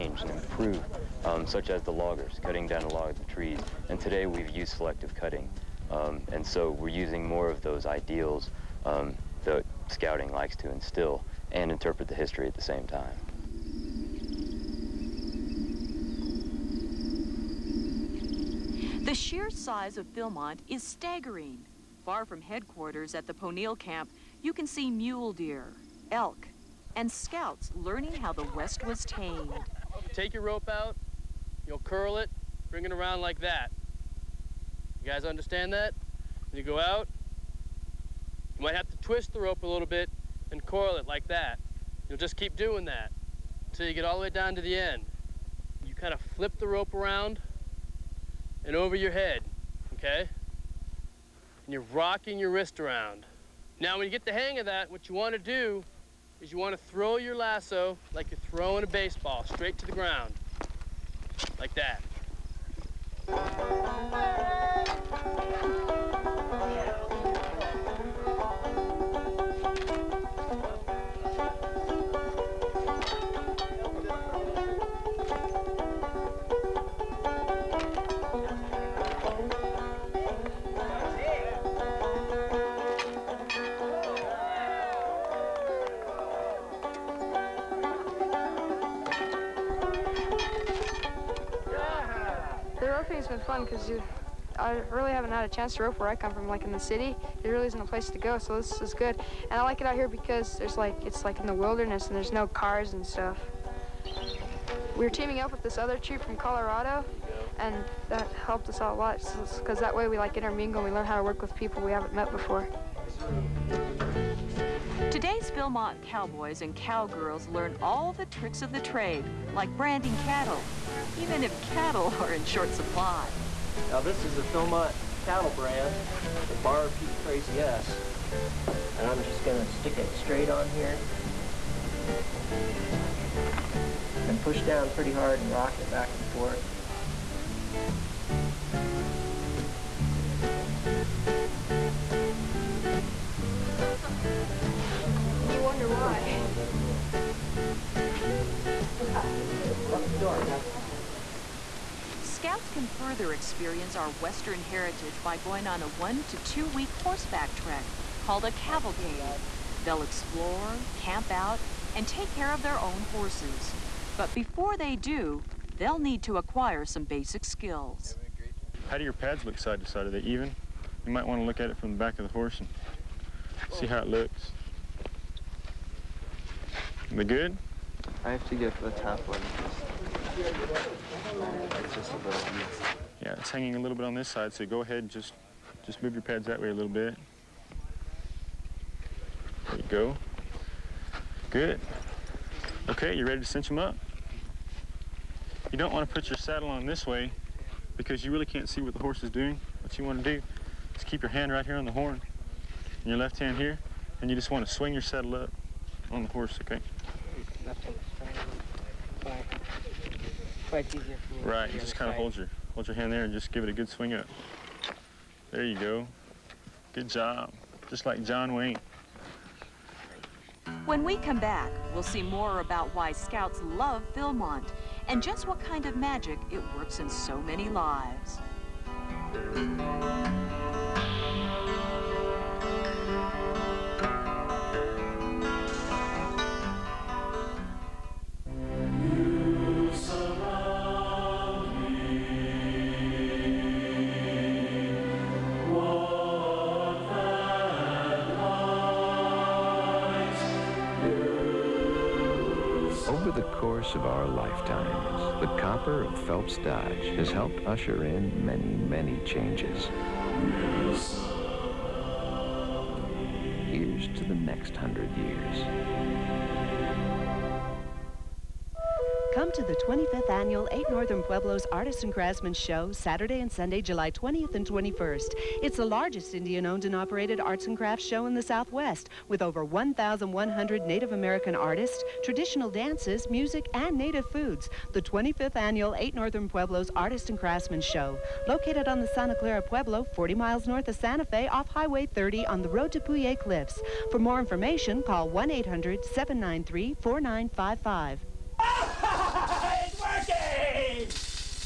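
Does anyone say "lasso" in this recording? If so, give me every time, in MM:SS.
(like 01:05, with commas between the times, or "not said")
00:57.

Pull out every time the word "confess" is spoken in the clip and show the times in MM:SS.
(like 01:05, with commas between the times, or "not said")
not said.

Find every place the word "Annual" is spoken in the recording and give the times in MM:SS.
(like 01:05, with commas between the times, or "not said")
04:30, 04:45.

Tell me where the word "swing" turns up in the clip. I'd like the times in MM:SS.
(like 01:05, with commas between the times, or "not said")
03:24, 03:33.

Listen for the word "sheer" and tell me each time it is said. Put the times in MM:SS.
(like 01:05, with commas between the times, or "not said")
00:19.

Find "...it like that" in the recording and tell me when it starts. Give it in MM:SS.
00:40.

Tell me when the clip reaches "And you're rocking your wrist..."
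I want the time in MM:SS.
00:51.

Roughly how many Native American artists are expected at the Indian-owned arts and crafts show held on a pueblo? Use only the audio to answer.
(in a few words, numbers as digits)
over 1,100.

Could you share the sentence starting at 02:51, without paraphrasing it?
You might want to look at it from the back of the horse and see how it looks.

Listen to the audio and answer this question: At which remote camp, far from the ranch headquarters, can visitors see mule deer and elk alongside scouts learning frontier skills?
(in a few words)
Ponil camp.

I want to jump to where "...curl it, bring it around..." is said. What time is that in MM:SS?
00:31.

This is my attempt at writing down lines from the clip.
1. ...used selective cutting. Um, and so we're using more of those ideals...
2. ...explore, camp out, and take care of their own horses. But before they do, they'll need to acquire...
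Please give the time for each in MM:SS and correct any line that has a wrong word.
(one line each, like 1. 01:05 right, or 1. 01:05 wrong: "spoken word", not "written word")
1. 00:04 right
2. 02:40 right.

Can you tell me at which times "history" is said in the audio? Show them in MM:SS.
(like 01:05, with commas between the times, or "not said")
00:12.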